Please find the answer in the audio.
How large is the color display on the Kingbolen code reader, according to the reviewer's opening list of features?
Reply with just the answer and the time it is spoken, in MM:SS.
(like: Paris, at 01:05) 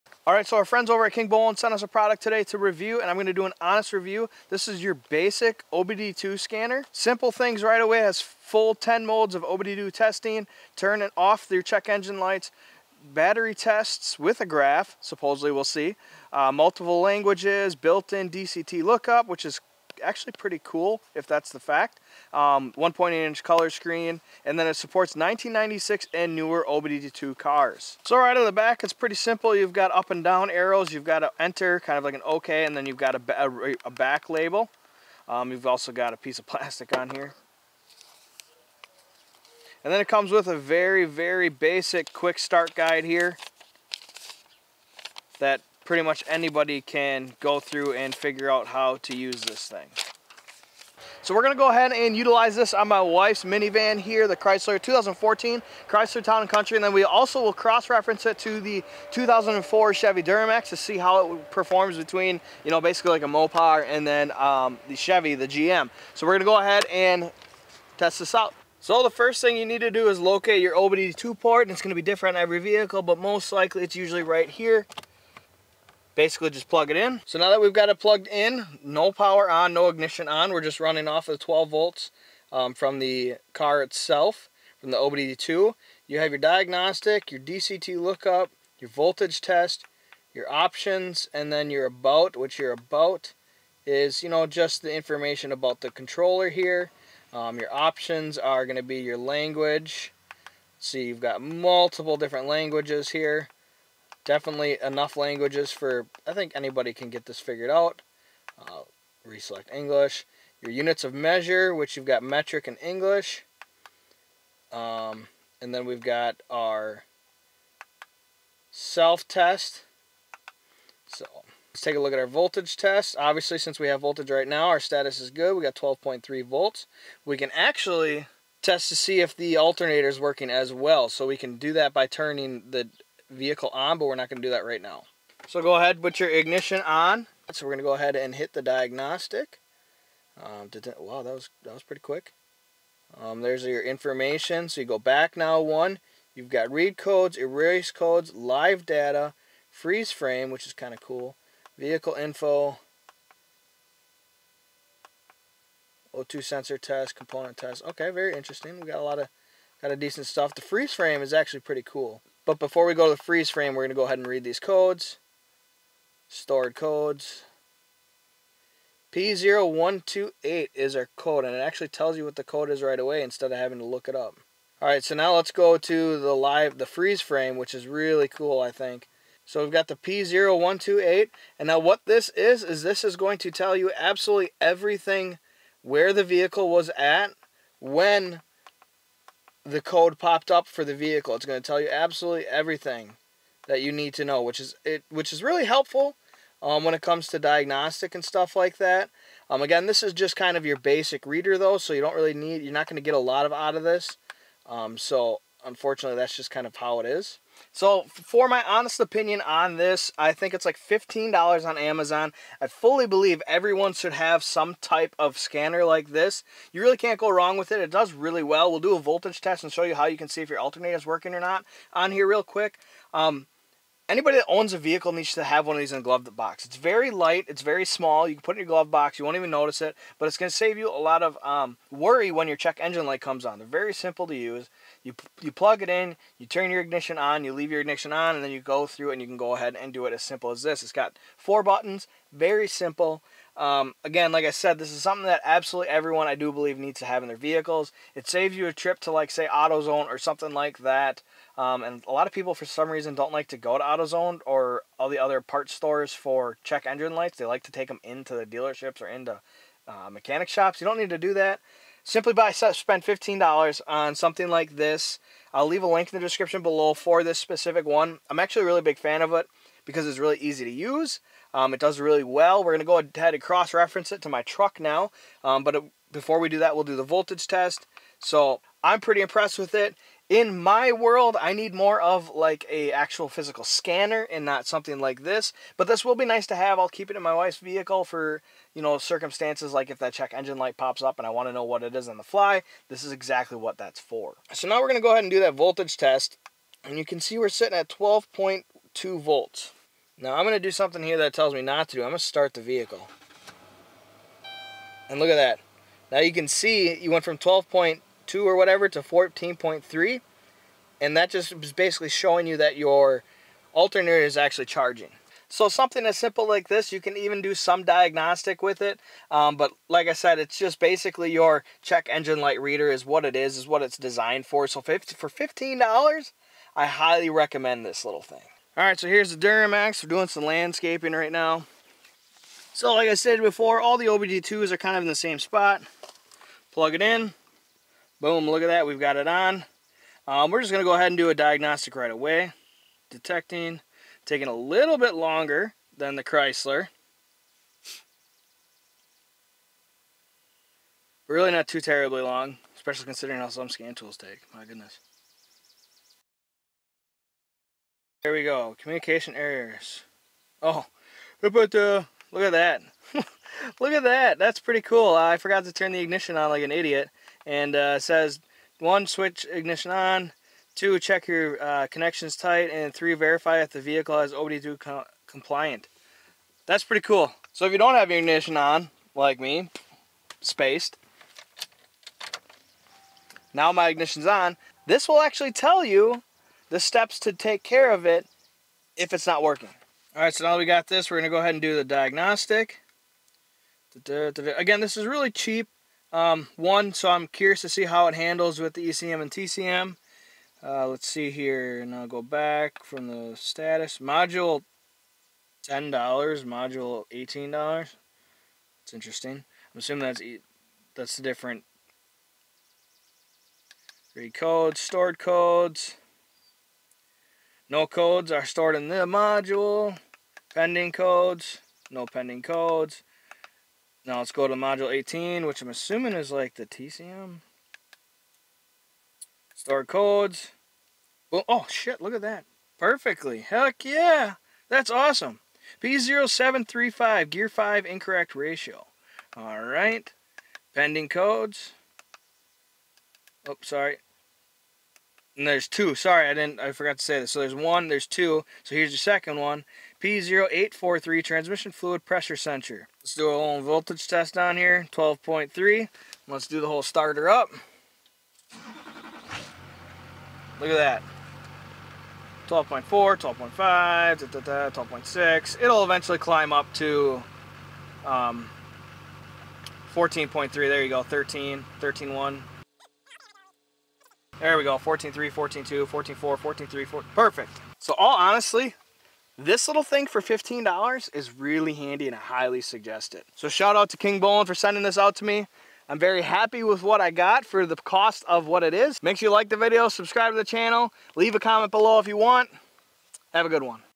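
1.8 inch, at 00:22.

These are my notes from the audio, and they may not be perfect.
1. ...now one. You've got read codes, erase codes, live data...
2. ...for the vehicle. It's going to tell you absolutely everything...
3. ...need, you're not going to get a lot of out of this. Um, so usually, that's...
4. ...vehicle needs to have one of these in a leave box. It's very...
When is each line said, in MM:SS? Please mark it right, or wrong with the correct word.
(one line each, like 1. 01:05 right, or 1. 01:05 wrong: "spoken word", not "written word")
1. 02:25 right
2. 03:10 right
3. 03:22 wrong: "unfortunately", not "usually"
4. 03:44 wrong: "glove", not "leave".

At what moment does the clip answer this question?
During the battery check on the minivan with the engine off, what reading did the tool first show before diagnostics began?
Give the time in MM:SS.
02:05.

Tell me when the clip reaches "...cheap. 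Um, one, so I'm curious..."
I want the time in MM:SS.
06:35.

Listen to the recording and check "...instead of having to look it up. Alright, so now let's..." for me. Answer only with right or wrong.
right.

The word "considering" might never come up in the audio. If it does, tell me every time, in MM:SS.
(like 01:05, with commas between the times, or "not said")
05:53.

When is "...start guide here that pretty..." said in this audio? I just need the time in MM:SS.
00:42.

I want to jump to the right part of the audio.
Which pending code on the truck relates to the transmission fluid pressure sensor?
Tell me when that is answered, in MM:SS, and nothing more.
07:30.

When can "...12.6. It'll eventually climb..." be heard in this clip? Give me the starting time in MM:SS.
07:44.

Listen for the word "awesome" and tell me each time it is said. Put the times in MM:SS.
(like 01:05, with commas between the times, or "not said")
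07:14.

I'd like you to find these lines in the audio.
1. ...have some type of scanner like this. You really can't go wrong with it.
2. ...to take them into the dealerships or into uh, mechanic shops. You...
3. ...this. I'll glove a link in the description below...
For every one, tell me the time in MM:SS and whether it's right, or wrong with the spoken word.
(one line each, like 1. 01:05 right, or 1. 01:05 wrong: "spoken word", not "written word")
1. 03:34 right
2. 04:17 right
3. 04:24 wrong: "leave", not "glove".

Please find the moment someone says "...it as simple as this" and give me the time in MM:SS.
04:00.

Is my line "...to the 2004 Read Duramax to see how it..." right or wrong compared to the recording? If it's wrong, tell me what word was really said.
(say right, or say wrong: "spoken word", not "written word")
wrong: "Chevy", not "Read".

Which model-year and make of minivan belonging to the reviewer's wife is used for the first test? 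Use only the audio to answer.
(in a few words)
2014 Chrysler.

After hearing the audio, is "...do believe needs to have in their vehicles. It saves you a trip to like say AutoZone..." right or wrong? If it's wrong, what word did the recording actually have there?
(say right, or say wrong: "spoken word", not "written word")
right.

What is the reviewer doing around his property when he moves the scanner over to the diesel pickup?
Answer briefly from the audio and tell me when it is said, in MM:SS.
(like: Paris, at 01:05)
landscaping, at 05:30.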